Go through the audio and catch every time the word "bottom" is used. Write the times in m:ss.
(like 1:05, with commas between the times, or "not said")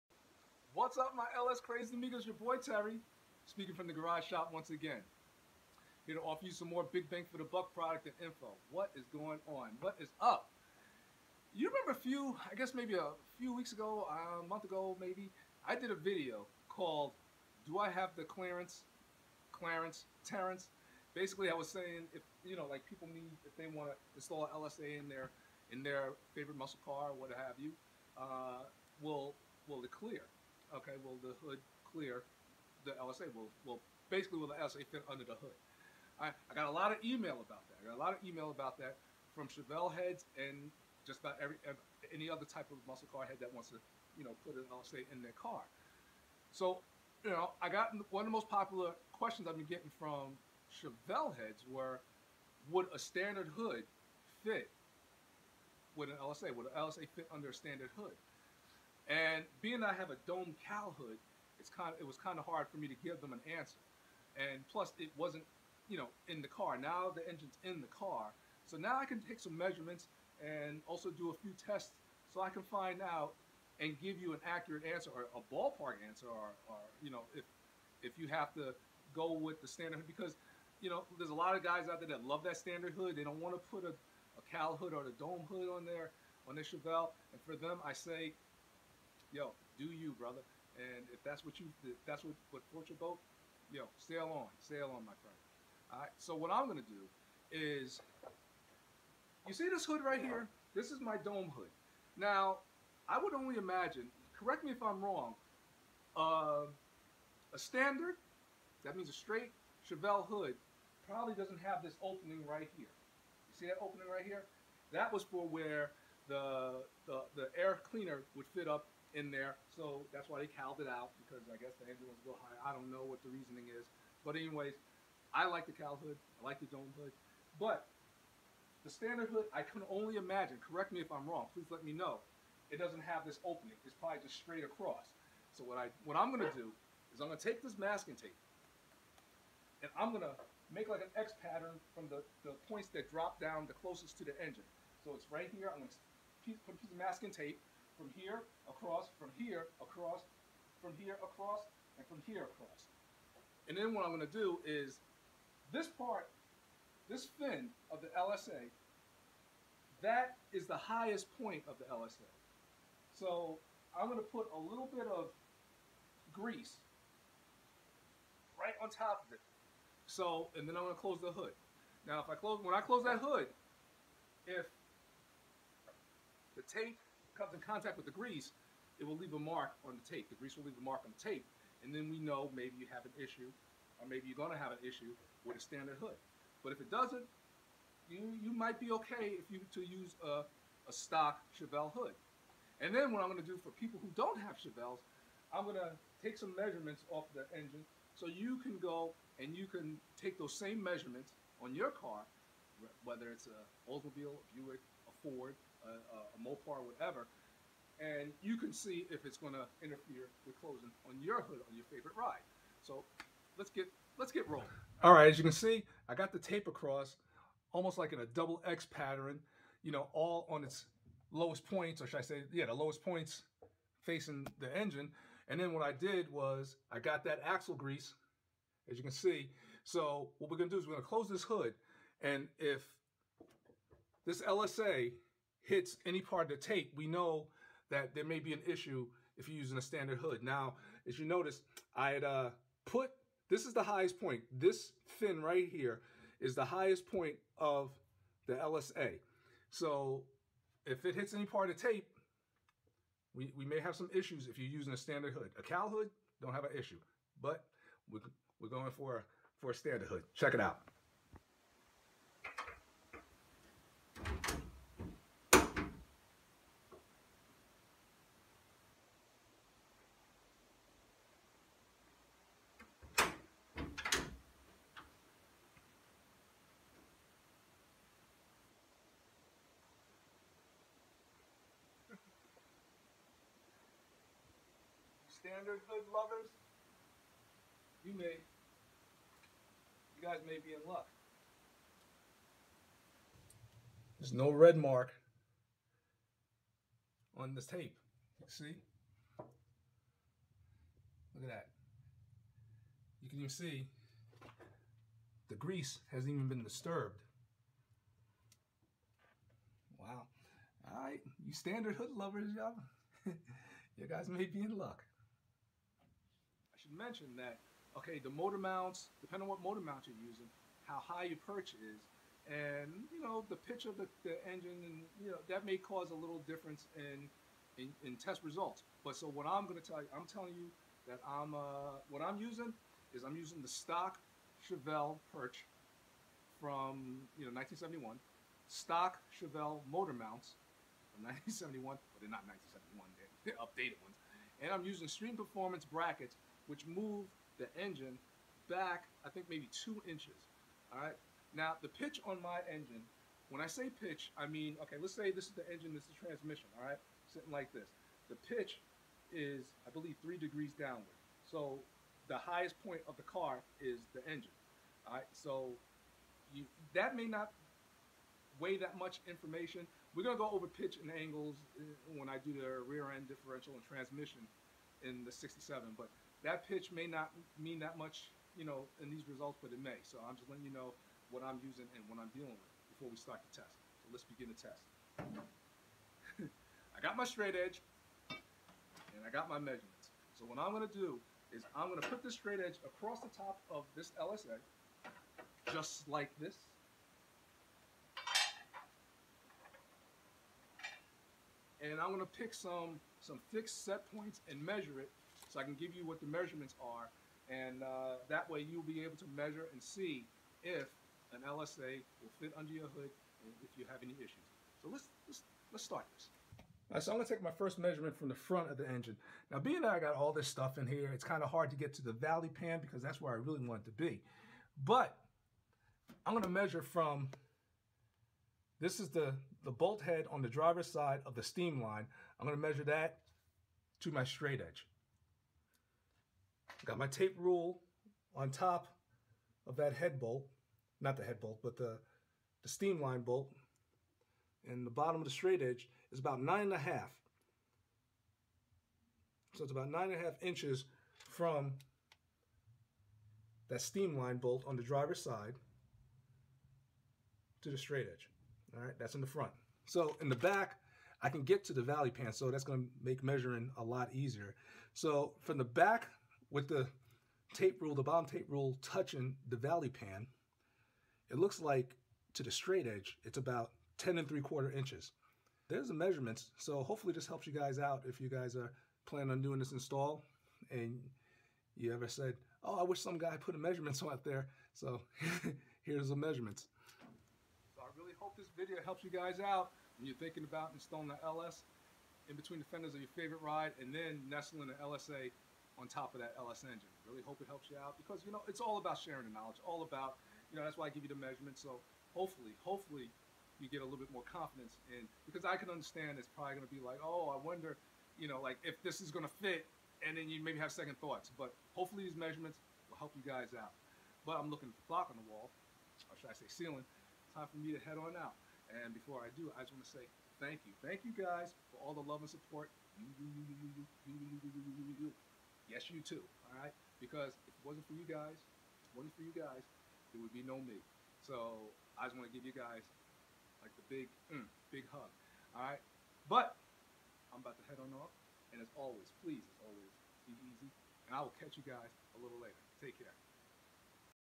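7:24, 7:48.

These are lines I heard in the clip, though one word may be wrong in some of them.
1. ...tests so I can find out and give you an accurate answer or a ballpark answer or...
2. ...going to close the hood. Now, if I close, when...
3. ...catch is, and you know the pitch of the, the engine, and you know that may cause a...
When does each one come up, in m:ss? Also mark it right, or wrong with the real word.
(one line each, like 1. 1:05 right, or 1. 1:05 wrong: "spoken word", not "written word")
1. 1:11 right
2. 2:50 right
3. 5:21 wrong: "perch", not "catch".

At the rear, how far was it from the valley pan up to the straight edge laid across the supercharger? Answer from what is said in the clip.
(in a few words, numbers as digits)
10 and 3/4 inches.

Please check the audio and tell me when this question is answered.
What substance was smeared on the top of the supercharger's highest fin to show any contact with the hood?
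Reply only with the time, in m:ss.
3:47.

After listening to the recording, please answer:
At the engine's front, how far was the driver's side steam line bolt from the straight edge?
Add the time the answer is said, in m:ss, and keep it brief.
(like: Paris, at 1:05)
9 and a half inches, at 7:29.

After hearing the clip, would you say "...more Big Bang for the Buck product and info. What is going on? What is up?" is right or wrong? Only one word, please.
right.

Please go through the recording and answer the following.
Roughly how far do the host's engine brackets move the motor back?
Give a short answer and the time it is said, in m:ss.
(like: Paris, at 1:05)
2 inches, at 5:49.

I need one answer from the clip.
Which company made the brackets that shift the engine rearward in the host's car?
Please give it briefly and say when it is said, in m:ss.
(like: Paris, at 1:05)
Stream Performance, at 5:45.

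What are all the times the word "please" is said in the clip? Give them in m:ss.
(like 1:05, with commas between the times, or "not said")
2:11, 8:59.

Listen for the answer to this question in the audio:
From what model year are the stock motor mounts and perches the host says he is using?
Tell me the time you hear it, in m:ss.
5:41.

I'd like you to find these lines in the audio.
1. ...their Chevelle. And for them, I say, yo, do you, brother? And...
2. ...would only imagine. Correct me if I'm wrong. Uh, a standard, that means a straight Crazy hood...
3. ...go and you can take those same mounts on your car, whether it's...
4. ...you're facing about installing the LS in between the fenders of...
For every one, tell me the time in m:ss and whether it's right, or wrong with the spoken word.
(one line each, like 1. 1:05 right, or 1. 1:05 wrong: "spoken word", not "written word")
1. 1:26 right
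2. 1:43 wrong: "Chevelle", not "Crazy"
3. 3:18 wrong: "measurements", not "mounts"
4. 8:10 wrong: "thinking", not "facing".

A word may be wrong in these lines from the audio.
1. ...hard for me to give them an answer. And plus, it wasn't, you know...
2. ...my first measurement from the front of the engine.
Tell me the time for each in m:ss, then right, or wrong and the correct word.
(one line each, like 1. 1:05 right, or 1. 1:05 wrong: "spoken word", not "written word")
1. 1:02 right
2. 6:57 right.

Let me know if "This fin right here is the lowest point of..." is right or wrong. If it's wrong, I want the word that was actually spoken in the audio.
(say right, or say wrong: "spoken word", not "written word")
wrong: "highest", not "lowest".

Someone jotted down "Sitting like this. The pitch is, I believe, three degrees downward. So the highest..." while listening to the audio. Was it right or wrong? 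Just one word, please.
right.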